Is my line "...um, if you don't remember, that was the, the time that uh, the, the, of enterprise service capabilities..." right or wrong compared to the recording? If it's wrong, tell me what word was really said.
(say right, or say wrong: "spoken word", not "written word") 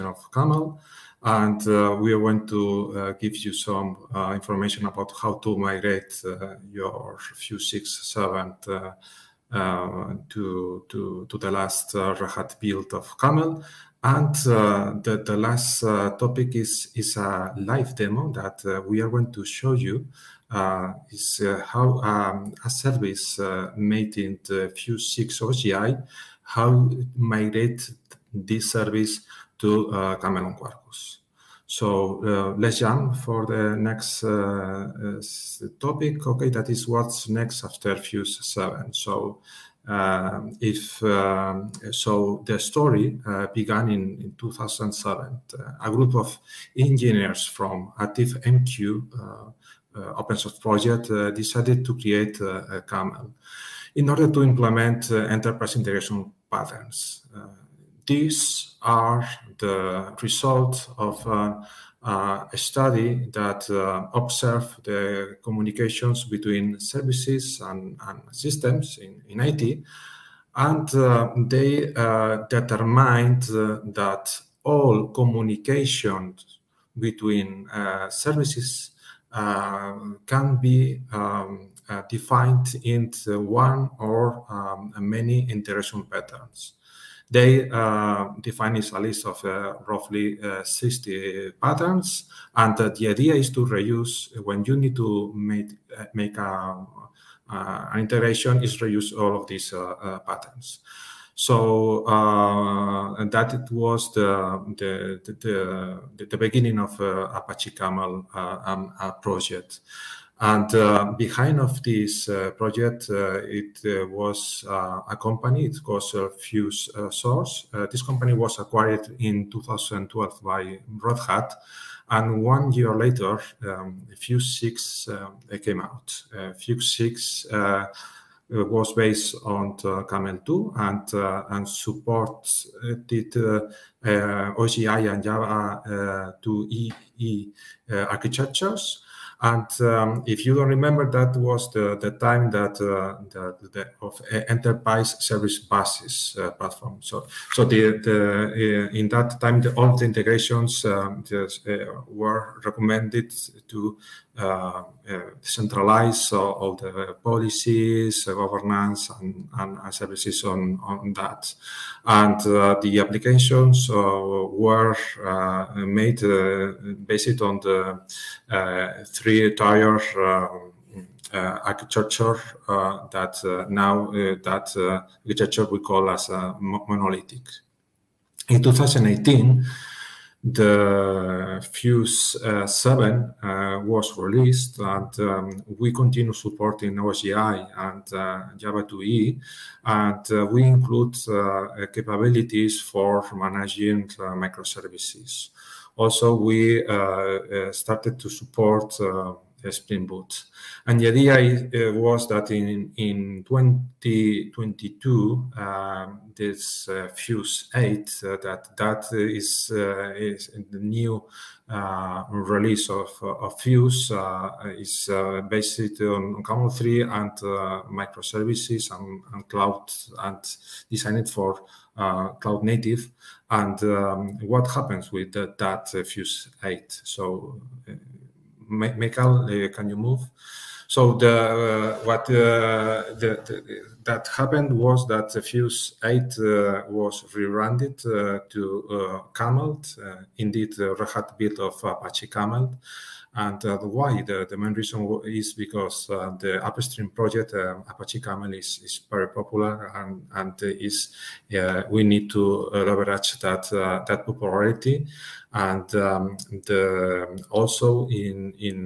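wrong: "buses", not "capabilities".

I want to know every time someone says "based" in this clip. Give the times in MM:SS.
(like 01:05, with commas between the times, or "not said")
02:08, 02:47, 03:35.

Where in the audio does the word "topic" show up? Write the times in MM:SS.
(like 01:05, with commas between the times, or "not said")
00:16, 00:35.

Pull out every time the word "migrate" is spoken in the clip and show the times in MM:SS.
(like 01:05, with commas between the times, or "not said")
00:05, 00:27.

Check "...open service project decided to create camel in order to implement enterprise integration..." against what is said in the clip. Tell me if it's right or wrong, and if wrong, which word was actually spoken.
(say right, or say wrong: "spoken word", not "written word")
wrong: "source", not "service".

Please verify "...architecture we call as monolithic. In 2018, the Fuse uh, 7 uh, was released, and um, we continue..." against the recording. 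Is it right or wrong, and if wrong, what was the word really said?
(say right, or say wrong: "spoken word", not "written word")
right.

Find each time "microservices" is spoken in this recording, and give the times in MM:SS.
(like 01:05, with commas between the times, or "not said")
03:14, 03:37.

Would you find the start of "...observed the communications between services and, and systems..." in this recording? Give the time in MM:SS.
01:04.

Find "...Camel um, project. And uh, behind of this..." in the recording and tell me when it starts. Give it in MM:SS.
01:47.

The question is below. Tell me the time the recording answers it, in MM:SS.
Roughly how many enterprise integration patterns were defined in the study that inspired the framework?
01:30.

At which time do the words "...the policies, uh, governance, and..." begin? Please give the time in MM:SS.
02:36.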